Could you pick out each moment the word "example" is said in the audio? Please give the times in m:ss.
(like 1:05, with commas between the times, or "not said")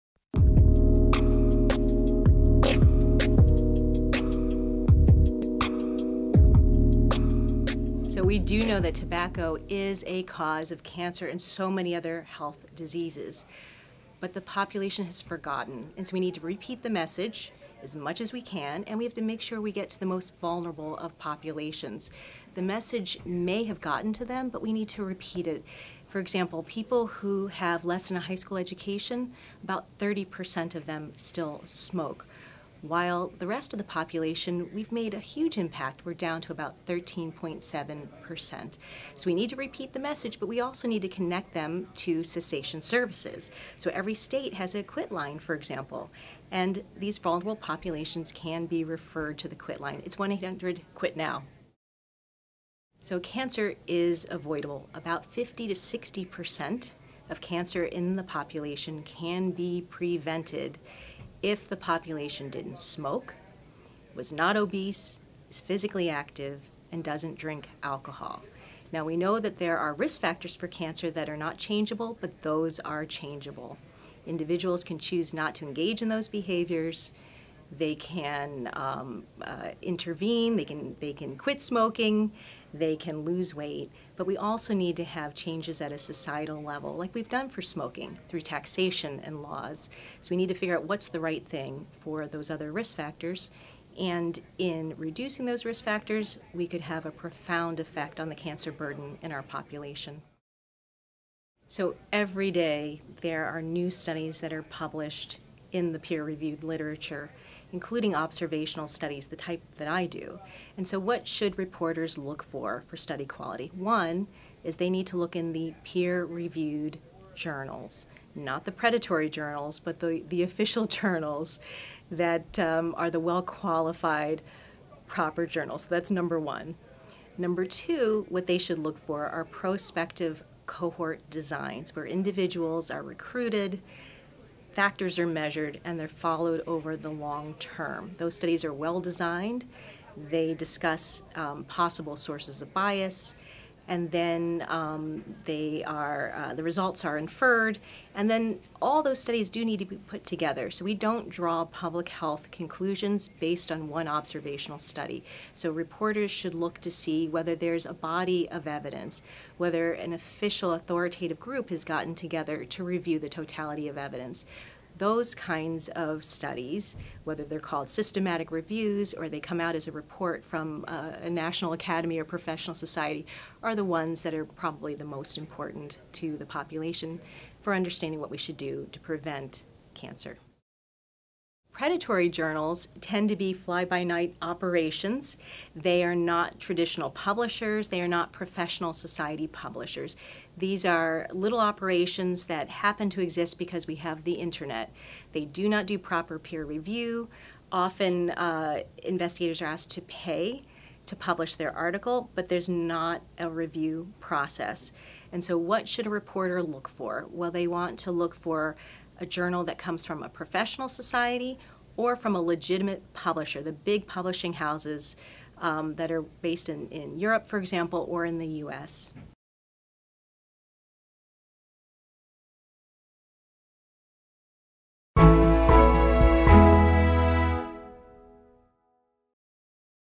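0:26, 0:45, 3:37.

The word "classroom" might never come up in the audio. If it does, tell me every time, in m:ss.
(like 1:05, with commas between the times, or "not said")
not said.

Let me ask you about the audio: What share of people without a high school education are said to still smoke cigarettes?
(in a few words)
30%.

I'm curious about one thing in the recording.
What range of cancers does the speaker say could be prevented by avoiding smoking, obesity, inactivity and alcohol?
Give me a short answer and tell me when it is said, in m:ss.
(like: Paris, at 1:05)
50 to 60%, at 0:55.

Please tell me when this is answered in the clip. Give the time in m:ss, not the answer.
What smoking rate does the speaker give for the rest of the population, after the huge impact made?
0:36.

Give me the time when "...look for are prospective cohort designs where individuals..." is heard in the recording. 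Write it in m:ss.
2:08.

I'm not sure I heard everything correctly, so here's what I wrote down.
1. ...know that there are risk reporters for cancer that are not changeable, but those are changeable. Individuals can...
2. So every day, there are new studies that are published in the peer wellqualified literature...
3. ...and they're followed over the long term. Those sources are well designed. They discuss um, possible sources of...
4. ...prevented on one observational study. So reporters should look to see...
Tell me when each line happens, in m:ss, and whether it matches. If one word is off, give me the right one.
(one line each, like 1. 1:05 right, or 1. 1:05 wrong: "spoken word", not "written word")
1. 1:09 wrong: "factors", not "reporters"
2. 1:41 wrong: "reviewed", not "wellqualified"
3. 2:15 wrong: "studies", not "sources"
4. 2:33 wrong: "based", not "prevented".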